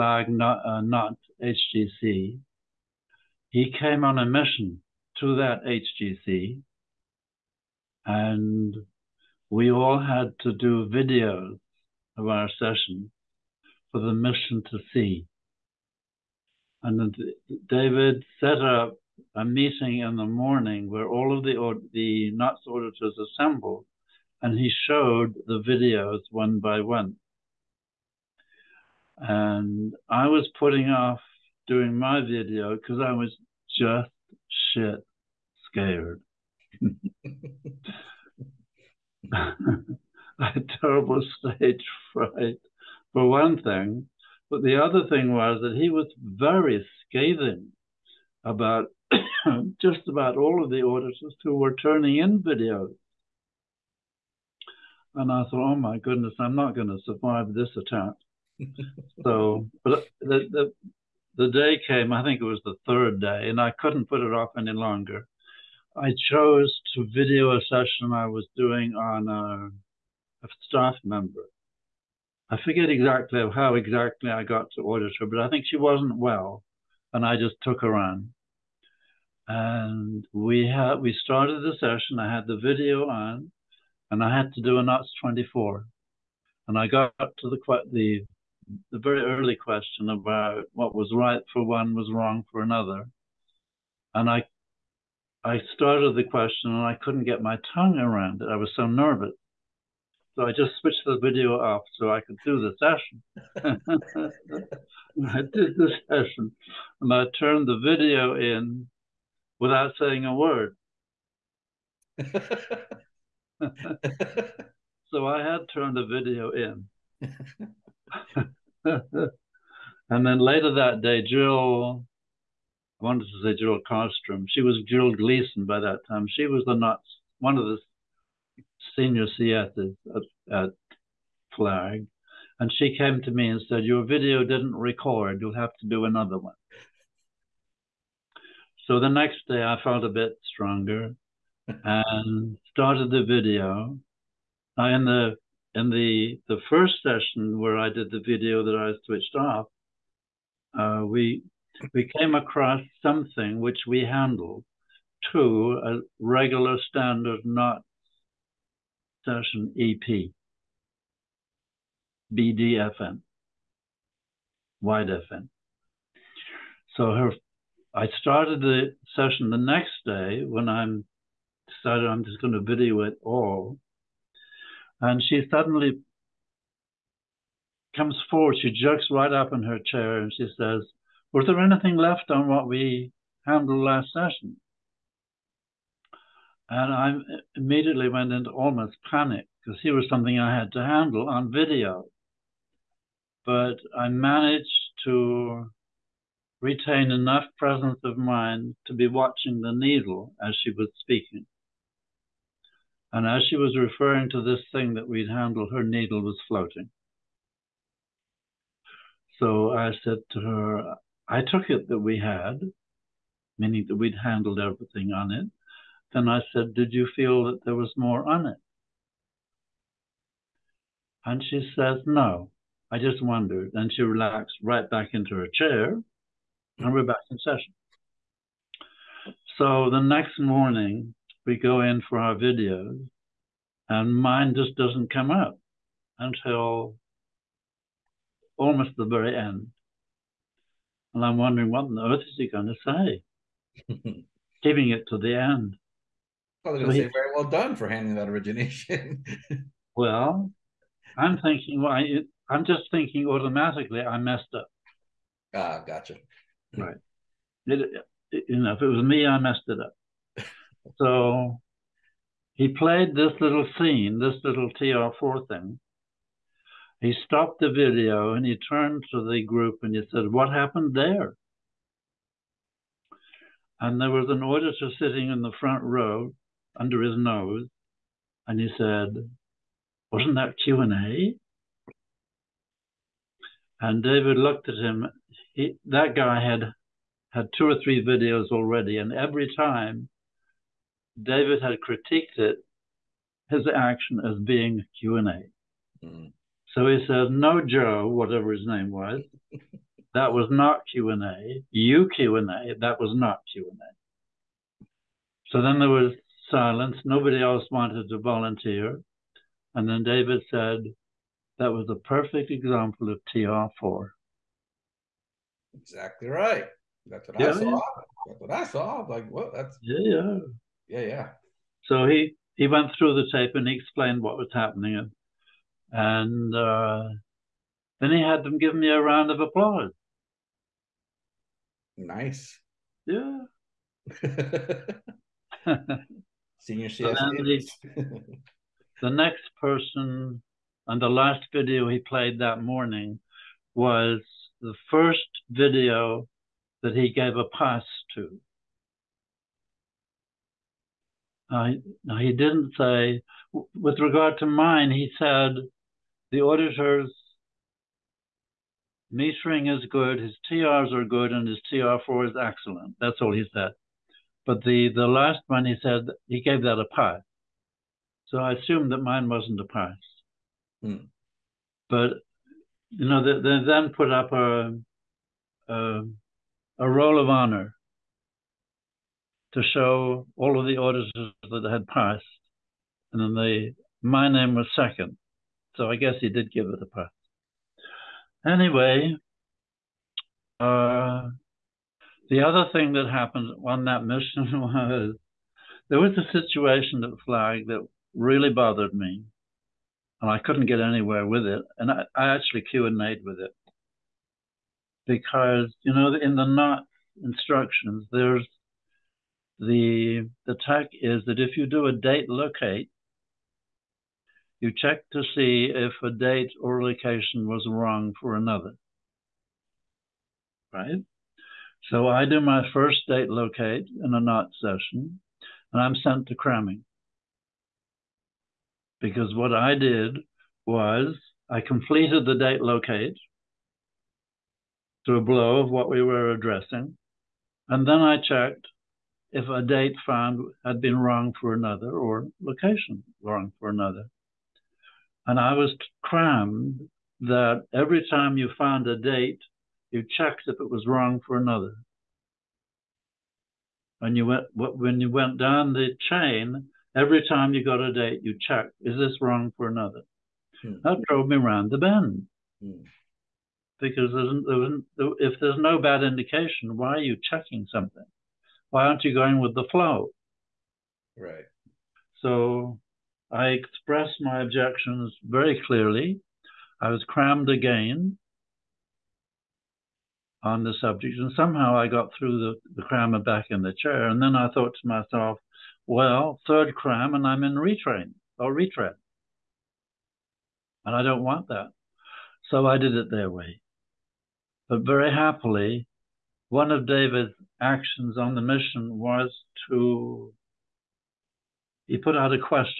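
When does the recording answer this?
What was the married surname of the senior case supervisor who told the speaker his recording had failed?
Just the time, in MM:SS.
02:05.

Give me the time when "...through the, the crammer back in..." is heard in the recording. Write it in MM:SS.
08:02.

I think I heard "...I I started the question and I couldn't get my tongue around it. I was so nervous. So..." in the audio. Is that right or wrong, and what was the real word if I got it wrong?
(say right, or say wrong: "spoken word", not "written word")
right.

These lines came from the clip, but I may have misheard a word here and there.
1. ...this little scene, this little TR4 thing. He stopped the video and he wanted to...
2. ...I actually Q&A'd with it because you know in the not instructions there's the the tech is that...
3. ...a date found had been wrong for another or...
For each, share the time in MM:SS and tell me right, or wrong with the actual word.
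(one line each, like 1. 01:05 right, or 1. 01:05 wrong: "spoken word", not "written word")
1. 04:23 wrong: "turned", not "wanted"
2. 06:42 right
3. 07:19 right.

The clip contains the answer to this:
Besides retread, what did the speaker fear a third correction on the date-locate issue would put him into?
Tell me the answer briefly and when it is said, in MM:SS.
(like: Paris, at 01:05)
retrain, at 08:07.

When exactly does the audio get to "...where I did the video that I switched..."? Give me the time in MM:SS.
02:27.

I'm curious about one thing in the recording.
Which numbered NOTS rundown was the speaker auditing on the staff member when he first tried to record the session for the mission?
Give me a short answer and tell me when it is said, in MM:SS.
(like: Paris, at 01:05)
NOTS 24, at 01:24.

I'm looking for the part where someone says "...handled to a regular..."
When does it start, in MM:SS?
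02:34.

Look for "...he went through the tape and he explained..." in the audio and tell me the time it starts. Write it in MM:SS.
05:22.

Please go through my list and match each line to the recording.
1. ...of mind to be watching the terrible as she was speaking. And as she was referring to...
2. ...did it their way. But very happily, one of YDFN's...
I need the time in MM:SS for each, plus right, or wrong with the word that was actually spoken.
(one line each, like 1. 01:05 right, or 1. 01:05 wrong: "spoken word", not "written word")
1. 03:18 wrong: "needle", not "terrible"
2. 08:12 wrong: "David", not "YDFN".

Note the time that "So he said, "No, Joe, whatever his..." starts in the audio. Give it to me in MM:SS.
04:56.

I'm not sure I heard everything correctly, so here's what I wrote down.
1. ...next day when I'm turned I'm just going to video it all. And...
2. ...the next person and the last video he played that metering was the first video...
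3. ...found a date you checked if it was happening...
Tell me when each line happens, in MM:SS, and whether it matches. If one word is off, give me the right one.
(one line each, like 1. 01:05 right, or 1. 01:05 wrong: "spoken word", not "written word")
1. 02:49 wrong: "decided", not "turned"
2. 05:39 wrong: "morning", not "metering"
3. 07:28 wrong: "wrong", not "happening".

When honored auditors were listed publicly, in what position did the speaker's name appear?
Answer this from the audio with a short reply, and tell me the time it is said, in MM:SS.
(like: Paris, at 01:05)
second, at 06:24.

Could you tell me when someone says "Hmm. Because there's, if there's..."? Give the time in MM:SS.
07:42.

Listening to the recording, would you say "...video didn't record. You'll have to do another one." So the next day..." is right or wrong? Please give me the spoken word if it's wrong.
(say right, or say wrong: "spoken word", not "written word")
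right.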